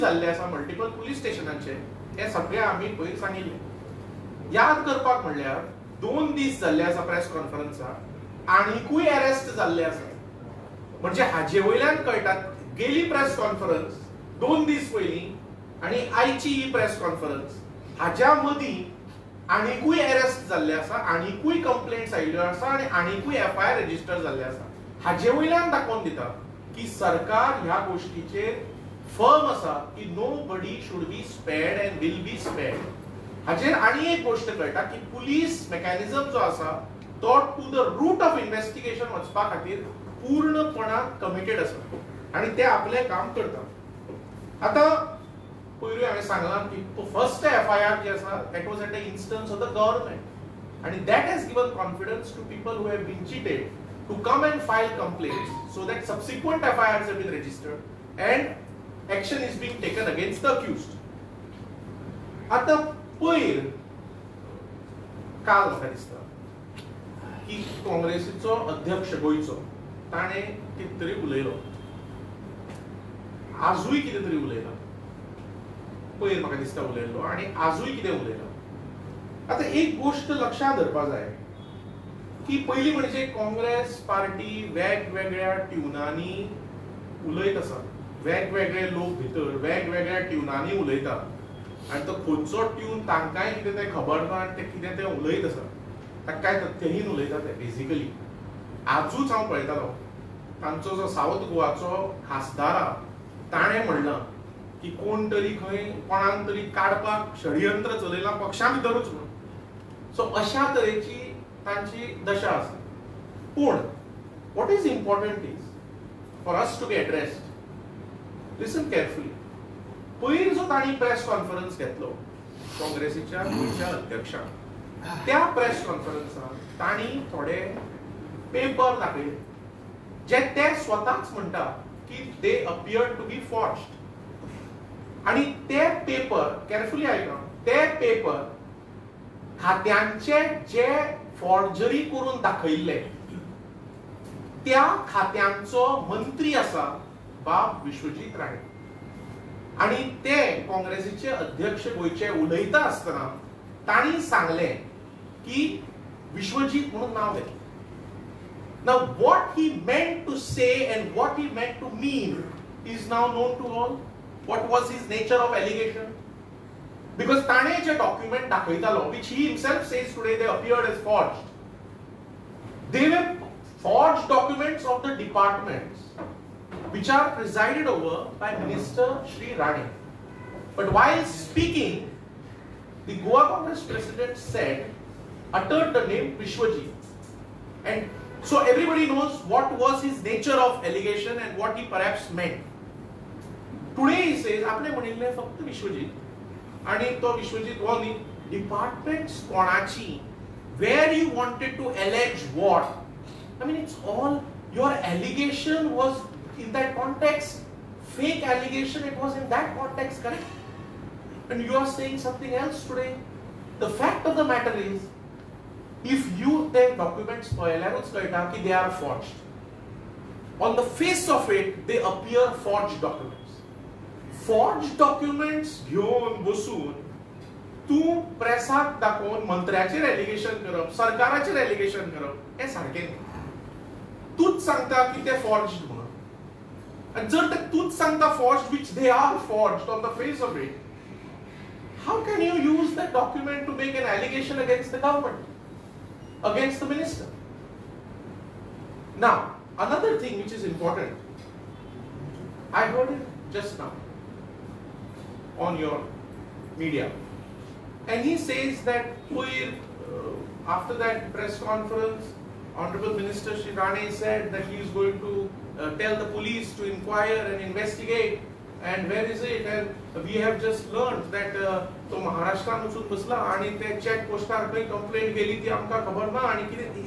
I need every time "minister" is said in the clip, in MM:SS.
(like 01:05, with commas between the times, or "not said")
02:58, 04:06, 04:23.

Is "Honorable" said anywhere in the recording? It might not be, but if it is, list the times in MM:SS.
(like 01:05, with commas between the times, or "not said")
04:22.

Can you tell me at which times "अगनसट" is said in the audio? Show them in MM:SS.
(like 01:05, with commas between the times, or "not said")
01:00, 04:04.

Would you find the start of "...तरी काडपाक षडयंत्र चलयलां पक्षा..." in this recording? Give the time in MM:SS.
01:46.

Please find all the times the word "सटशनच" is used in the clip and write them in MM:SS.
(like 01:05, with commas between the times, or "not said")
00:01.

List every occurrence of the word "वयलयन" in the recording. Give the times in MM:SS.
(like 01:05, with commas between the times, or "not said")
00:11, 00:25.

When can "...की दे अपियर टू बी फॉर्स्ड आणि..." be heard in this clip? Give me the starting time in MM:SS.
02:12.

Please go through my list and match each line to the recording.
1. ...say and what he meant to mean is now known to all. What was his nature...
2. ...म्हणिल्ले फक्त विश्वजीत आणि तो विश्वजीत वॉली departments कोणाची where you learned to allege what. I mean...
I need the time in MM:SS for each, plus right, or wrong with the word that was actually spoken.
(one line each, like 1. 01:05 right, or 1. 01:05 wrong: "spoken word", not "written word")
1. 02:40 right
2. 03:14 wrong: "wanted", not "learned".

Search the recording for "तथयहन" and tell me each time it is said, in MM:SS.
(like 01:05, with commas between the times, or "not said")
01:36.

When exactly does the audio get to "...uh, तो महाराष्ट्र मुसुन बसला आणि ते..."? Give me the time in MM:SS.
04:31.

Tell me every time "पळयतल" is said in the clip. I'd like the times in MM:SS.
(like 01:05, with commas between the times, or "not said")
01:39.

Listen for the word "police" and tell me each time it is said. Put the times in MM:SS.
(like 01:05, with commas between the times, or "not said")
04:26.